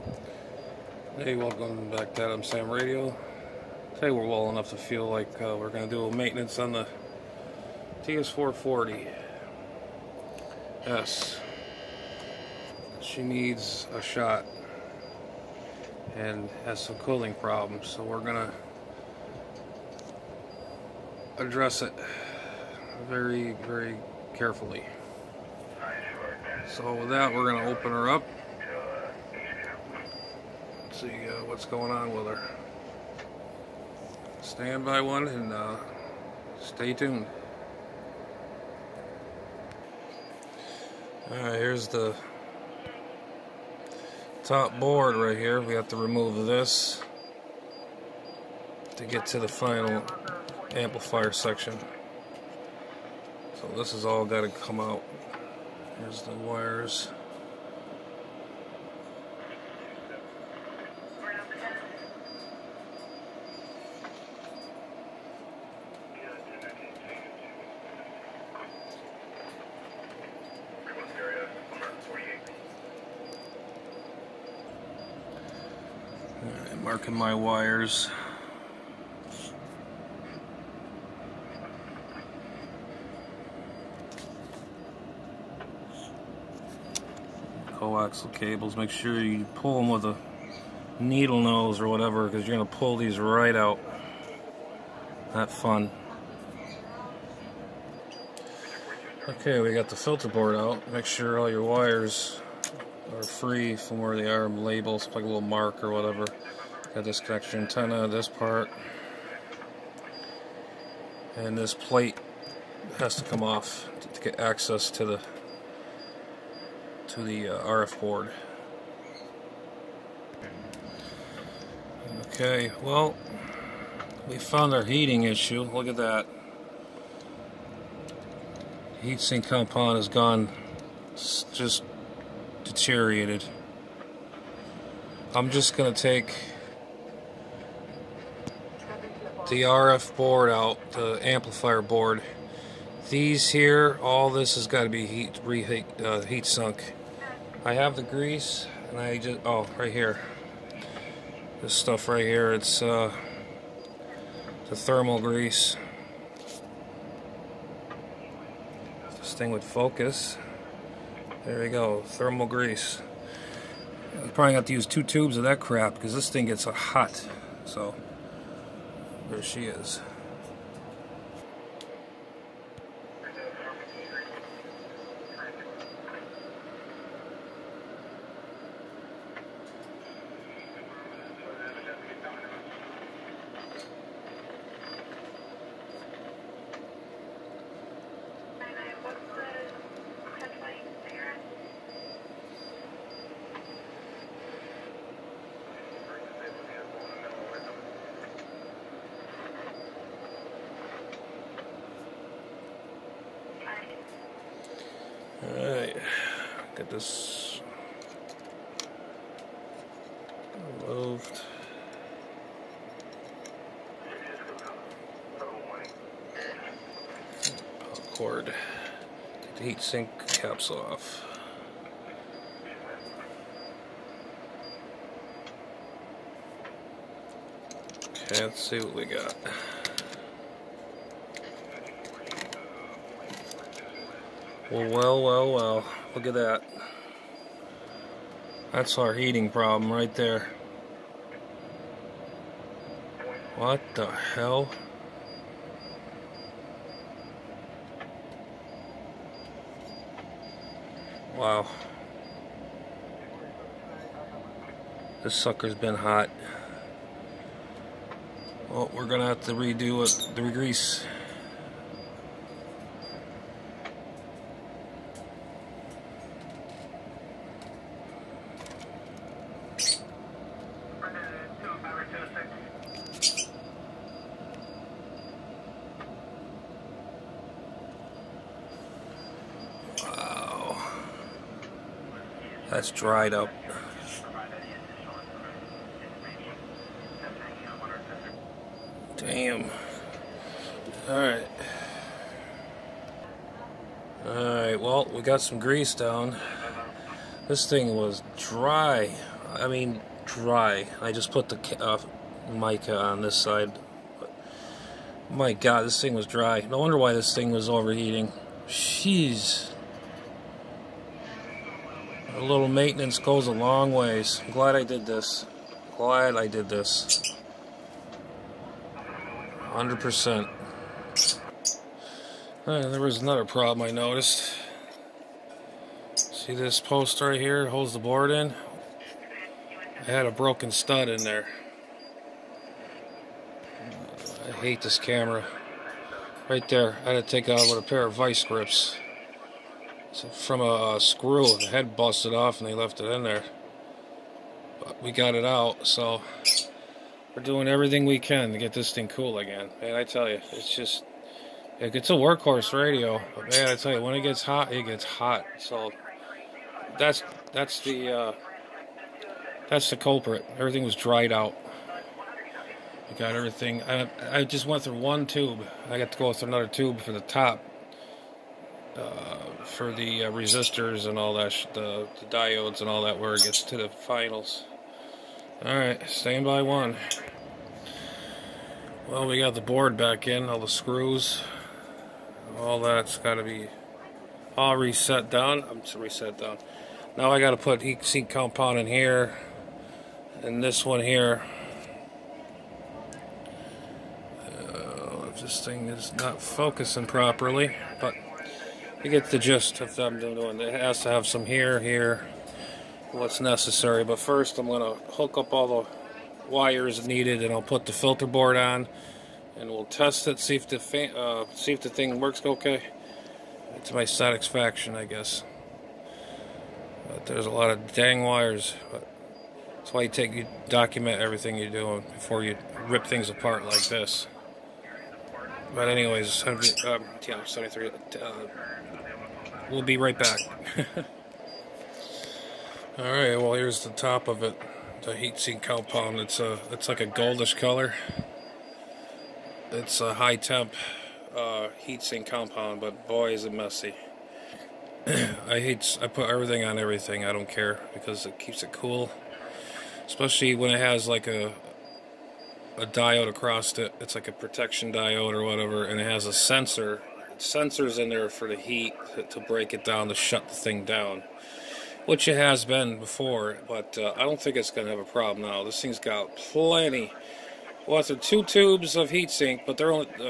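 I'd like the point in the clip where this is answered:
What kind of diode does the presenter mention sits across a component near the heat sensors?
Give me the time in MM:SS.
07:34.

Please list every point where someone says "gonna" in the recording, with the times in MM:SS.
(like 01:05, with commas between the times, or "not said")
02:44, 04:19.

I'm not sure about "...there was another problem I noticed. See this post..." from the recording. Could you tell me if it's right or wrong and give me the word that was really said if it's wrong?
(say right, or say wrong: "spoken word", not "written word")
right.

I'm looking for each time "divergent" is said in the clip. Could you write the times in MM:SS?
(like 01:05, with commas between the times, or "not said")
not said.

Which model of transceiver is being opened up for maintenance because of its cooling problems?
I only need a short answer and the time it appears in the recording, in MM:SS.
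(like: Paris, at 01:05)
TS440 S, at 00:08.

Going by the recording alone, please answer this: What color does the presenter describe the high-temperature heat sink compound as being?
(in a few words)
goldish.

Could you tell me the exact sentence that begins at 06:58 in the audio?
that's why you take you document everything you're doing before you rip things apart like this.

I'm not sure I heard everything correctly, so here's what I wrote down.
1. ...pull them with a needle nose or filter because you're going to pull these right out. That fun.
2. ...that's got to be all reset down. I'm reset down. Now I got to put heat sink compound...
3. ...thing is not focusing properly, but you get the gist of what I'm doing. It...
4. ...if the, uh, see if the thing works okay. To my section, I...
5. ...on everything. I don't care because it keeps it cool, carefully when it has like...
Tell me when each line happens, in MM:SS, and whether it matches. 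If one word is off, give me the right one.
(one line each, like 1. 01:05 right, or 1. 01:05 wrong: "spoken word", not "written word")
1. 01:29 wrong: "whatever", not "filter"
2. 06:22 right
3. 06:35 right
4. 06:50 wrong: "satisfaction", not "section"
5. 07:26 wrong: "especially", not "carefully".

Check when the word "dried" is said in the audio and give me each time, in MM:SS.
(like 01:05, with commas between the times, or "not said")
04:42, 06:00.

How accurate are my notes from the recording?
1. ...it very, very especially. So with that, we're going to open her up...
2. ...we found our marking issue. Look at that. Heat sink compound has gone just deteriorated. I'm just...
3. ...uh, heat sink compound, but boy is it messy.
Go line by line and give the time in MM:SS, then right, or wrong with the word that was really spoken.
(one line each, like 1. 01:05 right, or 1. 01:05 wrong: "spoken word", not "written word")
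1. 00:21 wrong: "carefully", not "especially"
2. 02:04 wrong: "heating", not "marking"
3. 07:21 right.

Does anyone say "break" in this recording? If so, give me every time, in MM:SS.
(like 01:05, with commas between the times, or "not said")
07:39.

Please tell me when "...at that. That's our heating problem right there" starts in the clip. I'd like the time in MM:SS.
03:56.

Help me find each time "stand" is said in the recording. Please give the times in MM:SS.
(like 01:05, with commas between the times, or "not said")
00:34, 06:16.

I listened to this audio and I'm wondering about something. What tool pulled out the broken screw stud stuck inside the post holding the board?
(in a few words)
vice grips.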